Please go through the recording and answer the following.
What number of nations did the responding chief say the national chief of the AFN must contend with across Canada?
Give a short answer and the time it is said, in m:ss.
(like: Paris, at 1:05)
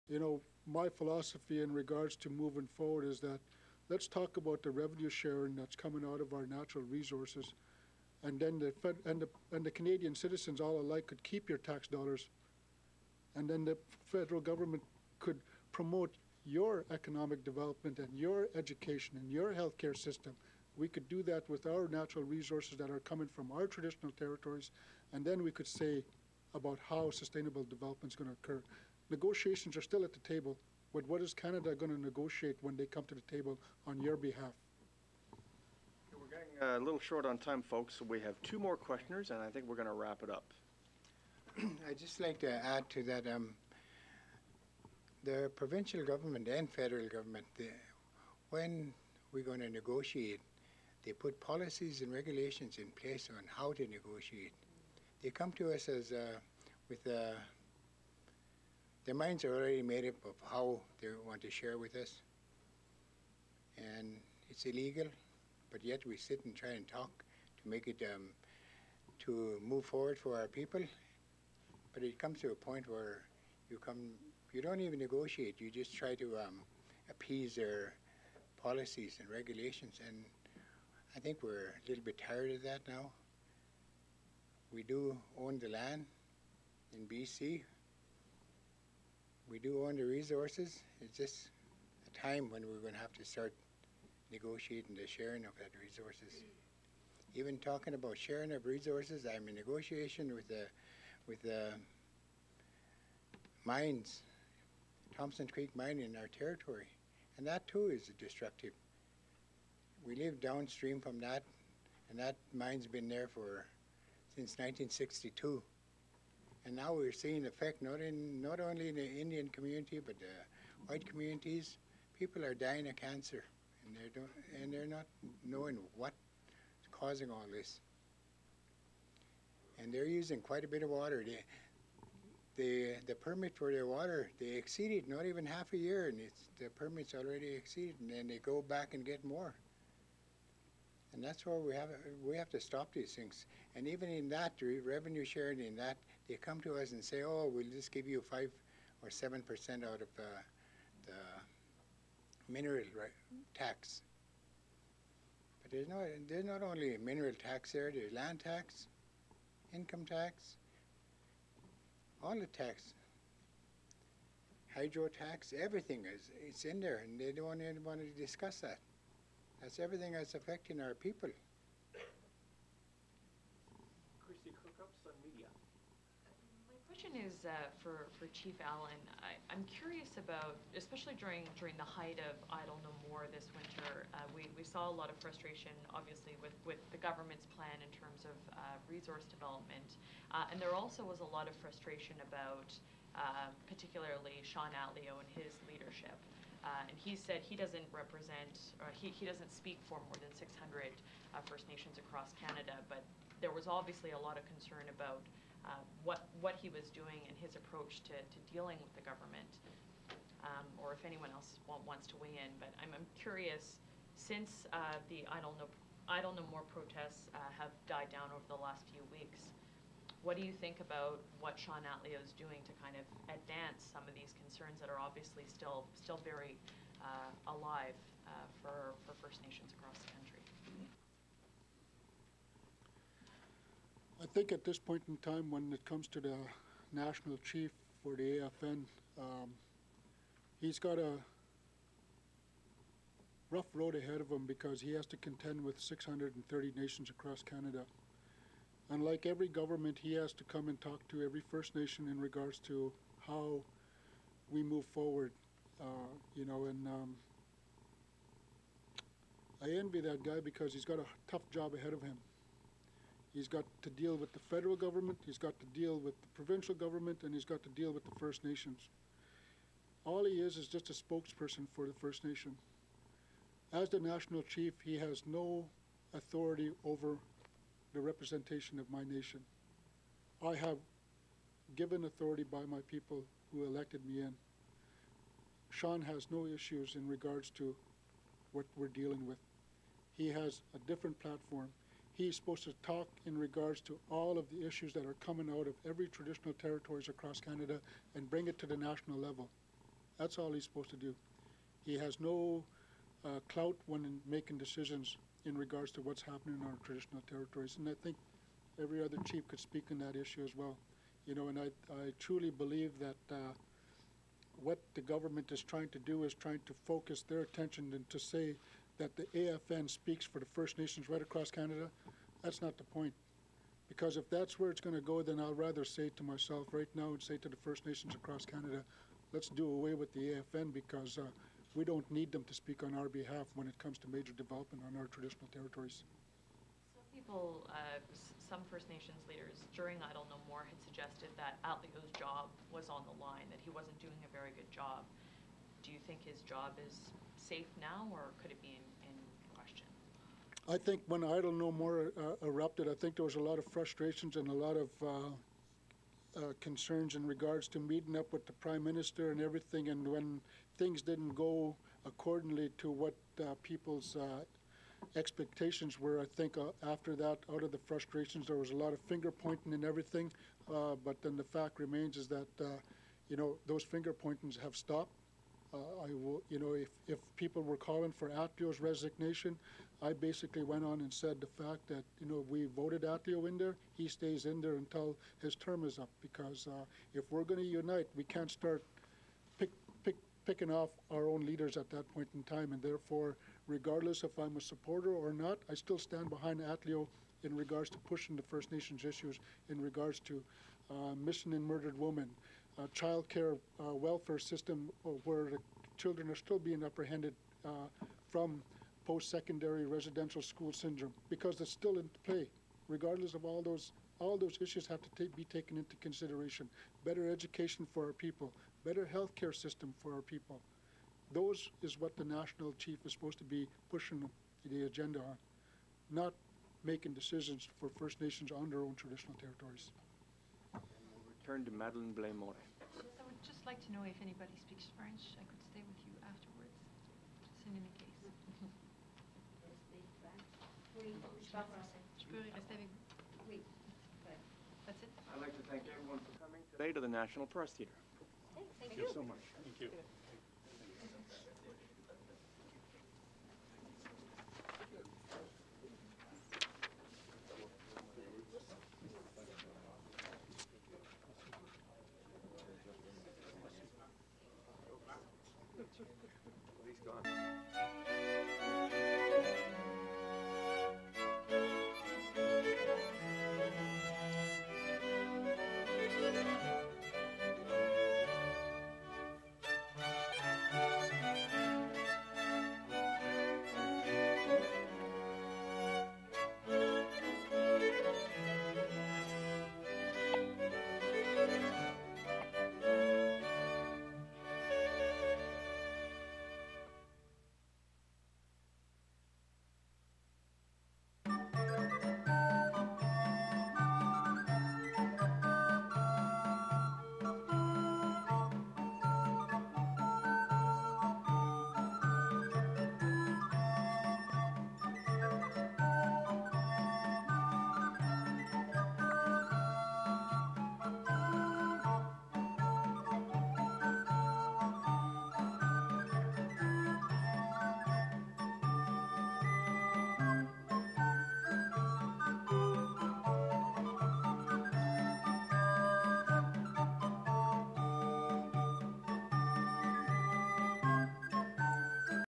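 630, at 4:05.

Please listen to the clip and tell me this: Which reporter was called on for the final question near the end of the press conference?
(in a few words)
Madeleine Blais-Morin.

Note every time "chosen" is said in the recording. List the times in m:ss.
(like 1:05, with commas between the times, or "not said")
not said.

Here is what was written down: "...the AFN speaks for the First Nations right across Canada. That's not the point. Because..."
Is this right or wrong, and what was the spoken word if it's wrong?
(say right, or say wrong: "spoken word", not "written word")
right.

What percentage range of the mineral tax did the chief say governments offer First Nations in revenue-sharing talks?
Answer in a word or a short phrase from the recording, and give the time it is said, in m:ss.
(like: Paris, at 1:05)
5 or 7%, at 2:28.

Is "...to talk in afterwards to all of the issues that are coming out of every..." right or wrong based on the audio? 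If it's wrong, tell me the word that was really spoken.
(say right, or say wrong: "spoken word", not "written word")
wrong: "regards", not "afterwards".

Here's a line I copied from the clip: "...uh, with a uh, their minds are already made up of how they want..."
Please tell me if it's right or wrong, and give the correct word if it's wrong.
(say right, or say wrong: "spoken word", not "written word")
right.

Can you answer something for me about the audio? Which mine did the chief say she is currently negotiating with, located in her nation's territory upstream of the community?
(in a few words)
Thompson Creek.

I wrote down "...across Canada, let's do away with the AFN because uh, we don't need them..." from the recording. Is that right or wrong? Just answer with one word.
right.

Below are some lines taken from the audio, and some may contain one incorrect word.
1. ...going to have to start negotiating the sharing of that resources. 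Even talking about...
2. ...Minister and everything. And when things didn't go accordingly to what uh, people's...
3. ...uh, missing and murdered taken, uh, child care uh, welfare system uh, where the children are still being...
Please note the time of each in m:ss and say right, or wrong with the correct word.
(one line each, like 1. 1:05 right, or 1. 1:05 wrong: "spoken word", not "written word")
1. 1:32 right
2. 5:58 right
3. 6:40 wrong: "women", not "taken".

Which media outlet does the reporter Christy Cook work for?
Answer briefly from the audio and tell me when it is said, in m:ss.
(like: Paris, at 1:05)
Sun Media, at 2:55.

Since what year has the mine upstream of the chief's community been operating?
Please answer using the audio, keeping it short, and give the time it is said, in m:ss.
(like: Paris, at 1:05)
1962, at 1:54.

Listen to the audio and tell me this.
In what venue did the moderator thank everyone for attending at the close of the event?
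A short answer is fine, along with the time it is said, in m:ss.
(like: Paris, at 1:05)
National Press Theater, at 7:27.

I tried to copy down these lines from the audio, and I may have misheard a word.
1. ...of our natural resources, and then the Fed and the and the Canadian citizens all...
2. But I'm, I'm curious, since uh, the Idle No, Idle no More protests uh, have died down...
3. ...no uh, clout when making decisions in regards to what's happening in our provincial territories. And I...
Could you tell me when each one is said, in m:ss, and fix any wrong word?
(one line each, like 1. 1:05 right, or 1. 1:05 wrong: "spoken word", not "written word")
1. 0:06 right
2. 3:32 right
3. 5:02 wrong: "traditional", not "provincial".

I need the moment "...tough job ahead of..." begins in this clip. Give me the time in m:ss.
4:21.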